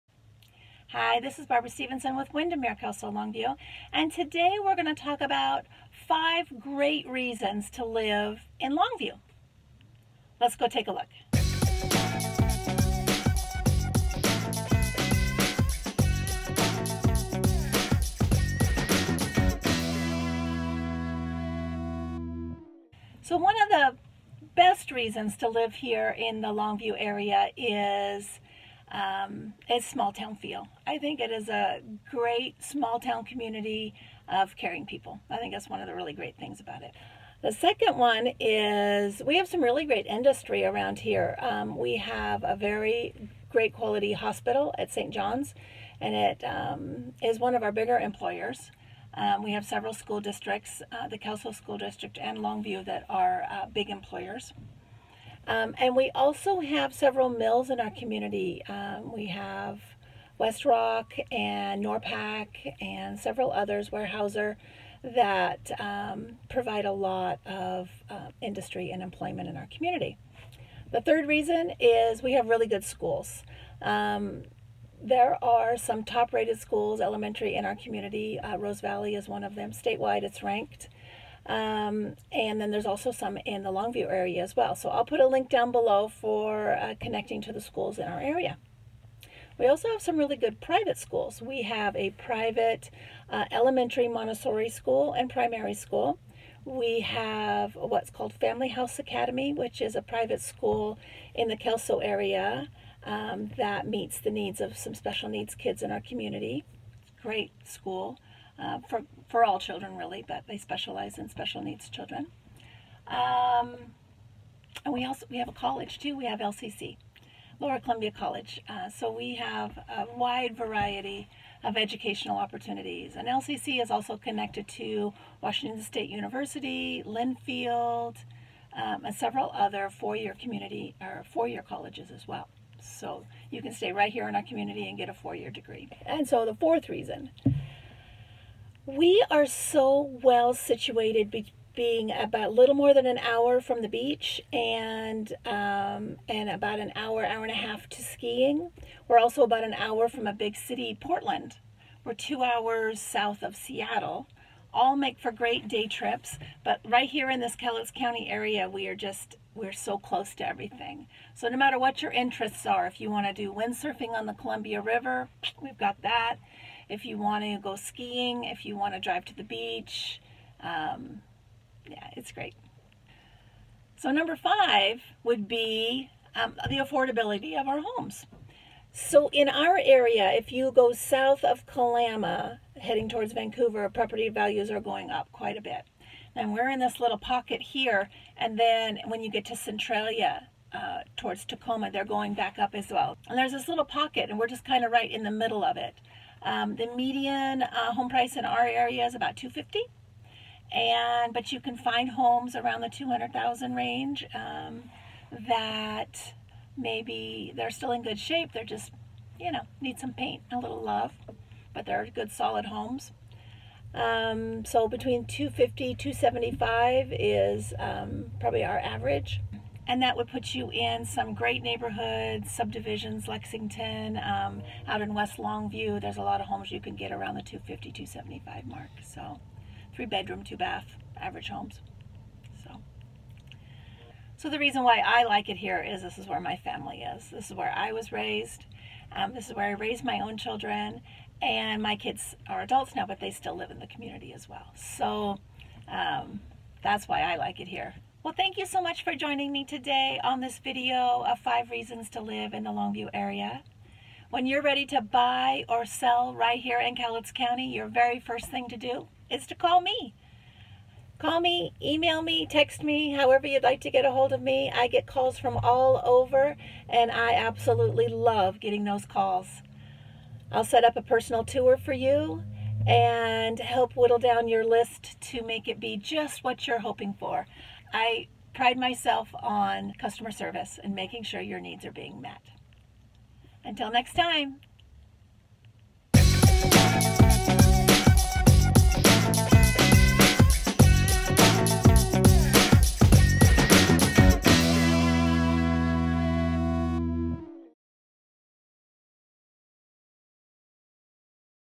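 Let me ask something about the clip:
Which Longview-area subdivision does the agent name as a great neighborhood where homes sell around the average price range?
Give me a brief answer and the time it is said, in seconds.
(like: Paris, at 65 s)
Lexington, at 223 s.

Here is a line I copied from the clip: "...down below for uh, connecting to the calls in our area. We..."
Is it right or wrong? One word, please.
wrong.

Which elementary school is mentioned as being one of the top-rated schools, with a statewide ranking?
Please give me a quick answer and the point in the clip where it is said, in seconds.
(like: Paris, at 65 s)
Rose Valley, at 78 s.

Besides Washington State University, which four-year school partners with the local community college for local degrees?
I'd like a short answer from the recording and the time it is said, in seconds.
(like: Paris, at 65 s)
Linfield, at 127 s.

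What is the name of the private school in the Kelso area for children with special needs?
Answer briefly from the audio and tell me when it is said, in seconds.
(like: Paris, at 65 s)
Family House Academy, at 98 s.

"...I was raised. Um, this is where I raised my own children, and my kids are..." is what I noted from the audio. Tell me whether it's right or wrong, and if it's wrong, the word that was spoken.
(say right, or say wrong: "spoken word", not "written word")
right.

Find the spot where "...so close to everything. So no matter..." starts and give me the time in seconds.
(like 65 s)
159 s.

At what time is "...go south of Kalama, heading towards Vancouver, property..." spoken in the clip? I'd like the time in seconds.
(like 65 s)
180 s.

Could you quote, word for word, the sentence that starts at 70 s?
The third reason is we have really good schools.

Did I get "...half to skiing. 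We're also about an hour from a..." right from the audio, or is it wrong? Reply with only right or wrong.
right.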